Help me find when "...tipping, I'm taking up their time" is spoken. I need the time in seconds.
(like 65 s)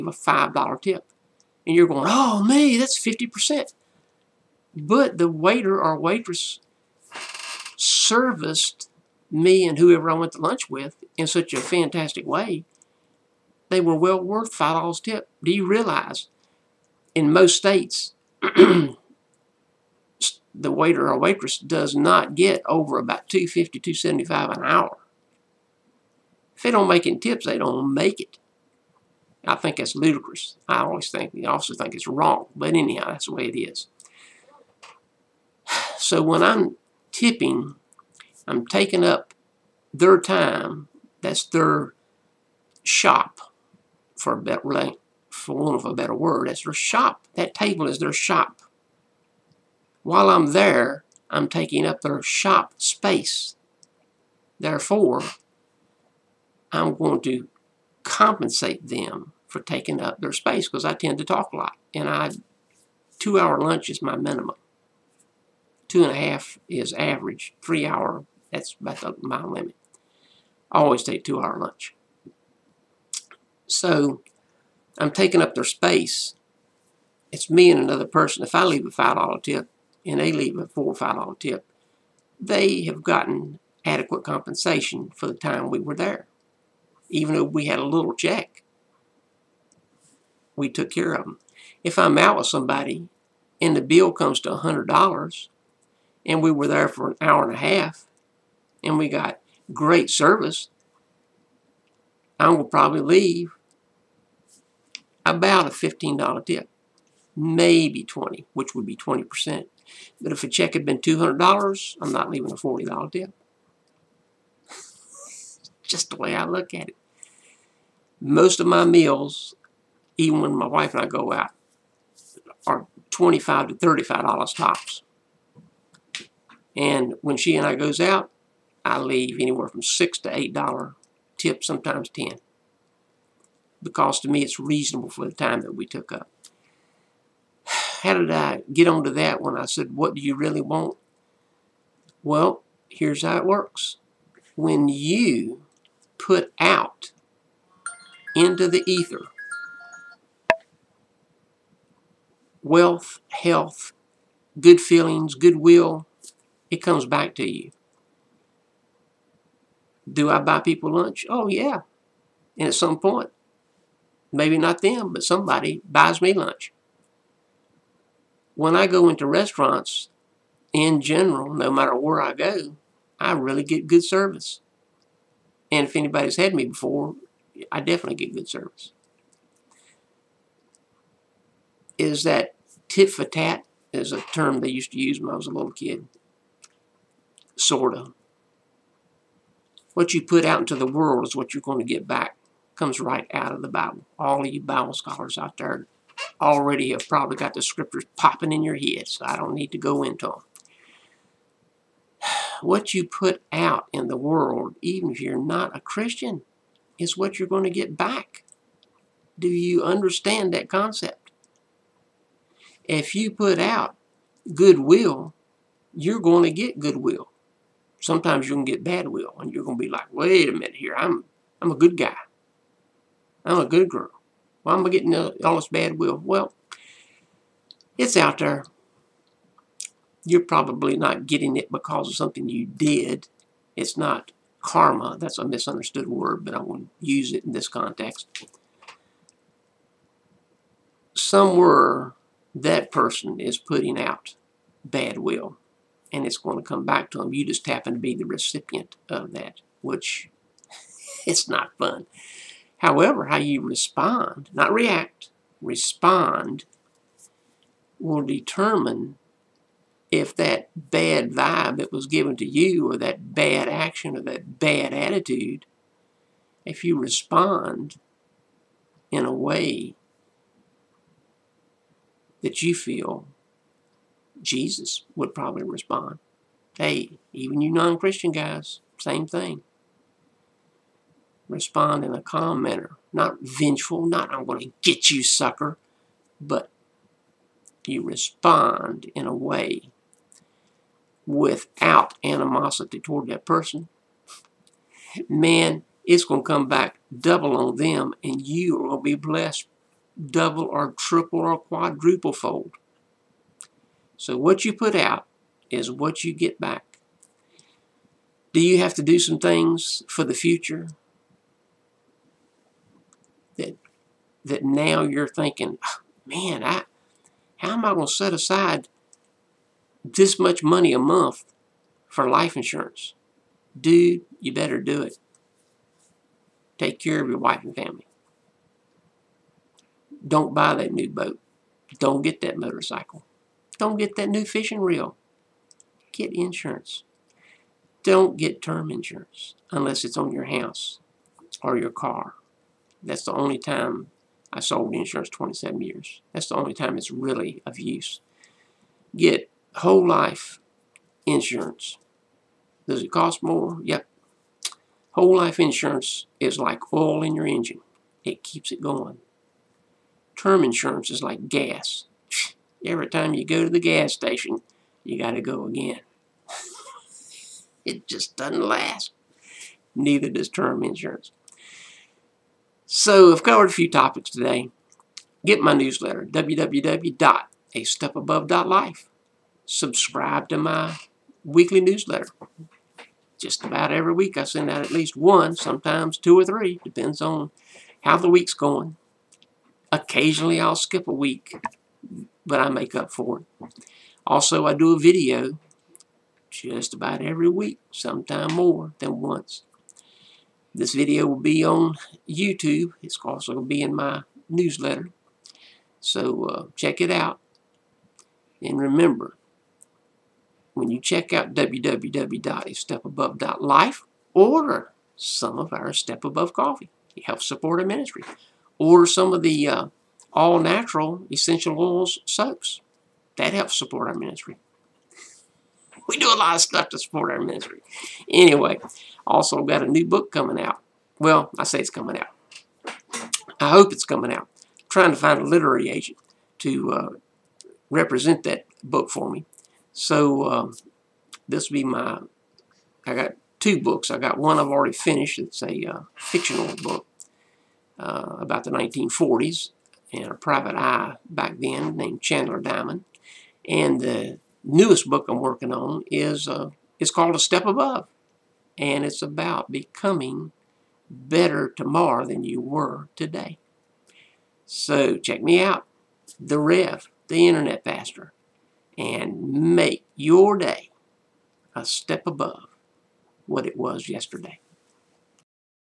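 37 s.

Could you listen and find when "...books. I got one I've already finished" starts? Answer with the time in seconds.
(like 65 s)
443 s.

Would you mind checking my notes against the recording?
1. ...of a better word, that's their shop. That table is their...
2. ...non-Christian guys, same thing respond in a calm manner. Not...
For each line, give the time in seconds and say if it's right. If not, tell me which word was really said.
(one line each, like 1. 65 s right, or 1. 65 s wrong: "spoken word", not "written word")
1. 45 s right
2. 277 s right.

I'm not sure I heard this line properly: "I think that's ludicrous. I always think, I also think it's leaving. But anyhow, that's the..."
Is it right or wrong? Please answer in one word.
wrong.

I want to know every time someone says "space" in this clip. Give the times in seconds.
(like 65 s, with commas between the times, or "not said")
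52 s, 60 s, 75 s.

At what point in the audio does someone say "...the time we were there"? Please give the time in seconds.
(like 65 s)
85 s.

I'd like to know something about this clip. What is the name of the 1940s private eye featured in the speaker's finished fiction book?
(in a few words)
Chandler Diamond.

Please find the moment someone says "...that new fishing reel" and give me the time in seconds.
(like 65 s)
334 s.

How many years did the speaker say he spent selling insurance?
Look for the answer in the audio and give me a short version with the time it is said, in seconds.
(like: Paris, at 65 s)
27 years, at 345 s.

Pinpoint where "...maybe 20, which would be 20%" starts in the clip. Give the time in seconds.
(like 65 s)
107 s.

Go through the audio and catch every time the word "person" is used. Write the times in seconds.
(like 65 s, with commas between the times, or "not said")
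78 s, 242 s, 293 s.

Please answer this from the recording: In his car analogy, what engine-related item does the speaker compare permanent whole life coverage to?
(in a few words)
Oil.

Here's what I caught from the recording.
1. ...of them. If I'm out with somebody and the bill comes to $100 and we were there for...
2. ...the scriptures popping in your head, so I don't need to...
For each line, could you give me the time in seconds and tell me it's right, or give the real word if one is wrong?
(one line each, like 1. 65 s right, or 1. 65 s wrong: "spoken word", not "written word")
1. 91 s right
2. 197 s right.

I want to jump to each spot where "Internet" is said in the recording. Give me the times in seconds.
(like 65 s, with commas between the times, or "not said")
467 s.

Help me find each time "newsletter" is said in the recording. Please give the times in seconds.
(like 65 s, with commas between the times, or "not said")
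375 s, 381 s, 404 s.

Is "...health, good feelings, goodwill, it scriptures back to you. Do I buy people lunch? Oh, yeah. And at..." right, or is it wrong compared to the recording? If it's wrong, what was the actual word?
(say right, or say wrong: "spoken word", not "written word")
wrong: "comes", not "scriptures".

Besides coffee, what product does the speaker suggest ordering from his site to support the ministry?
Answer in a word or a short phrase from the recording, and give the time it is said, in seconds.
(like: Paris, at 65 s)
Essential oils soaps, at 421 s.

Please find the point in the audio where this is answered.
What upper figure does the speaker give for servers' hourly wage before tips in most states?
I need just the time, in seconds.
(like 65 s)
23 s.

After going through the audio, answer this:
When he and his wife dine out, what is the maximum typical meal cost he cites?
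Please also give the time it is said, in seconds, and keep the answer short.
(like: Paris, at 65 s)
$35, at 123 s.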